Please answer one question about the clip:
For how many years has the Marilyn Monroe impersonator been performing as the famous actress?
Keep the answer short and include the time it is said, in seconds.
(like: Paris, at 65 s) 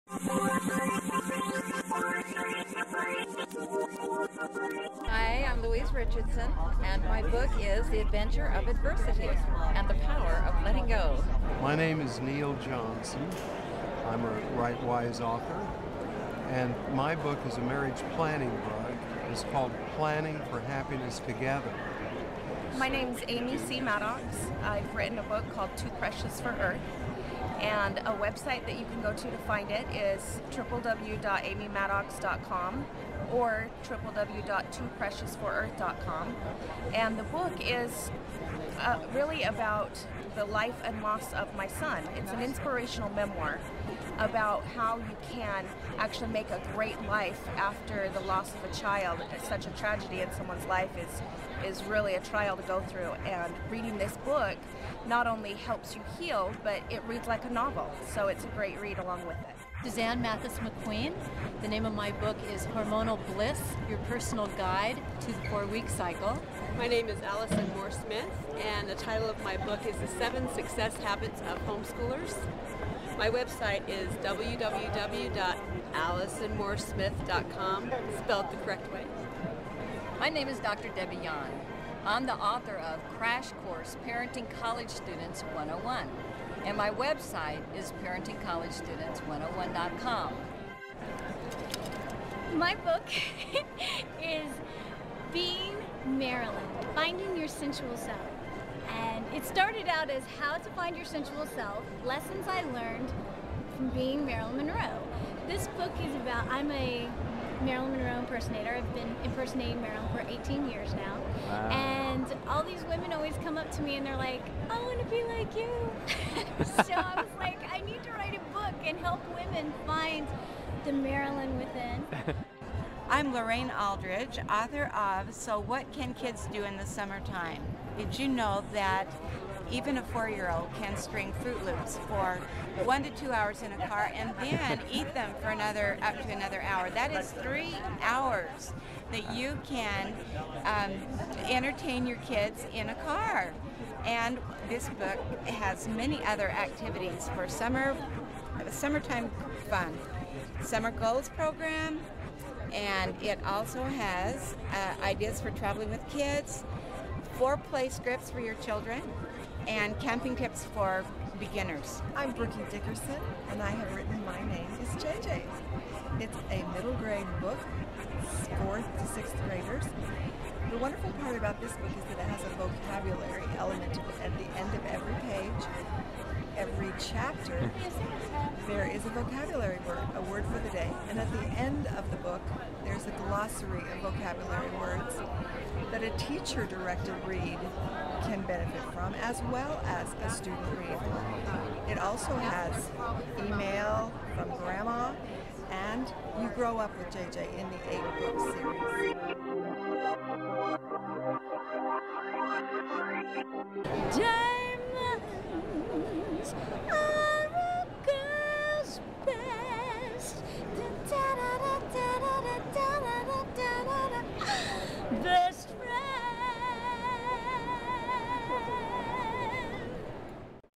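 18, at 110 s.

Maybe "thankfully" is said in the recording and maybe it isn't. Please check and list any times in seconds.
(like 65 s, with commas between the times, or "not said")
not said.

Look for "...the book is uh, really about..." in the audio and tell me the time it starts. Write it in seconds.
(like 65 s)
37 s.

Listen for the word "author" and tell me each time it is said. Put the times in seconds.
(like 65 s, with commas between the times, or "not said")
15 s, 82 s, 124 s.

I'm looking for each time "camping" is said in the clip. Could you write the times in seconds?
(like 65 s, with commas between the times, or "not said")
159 s.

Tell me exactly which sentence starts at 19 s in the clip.
It's called Planning for Happiness Together.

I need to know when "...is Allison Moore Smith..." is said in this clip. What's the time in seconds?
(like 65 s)
67 s.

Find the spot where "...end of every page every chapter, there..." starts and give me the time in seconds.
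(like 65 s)
174 s.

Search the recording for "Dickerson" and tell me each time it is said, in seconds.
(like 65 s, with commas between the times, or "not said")
162 s.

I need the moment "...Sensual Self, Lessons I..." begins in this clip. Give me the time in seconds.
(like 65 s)
101 s.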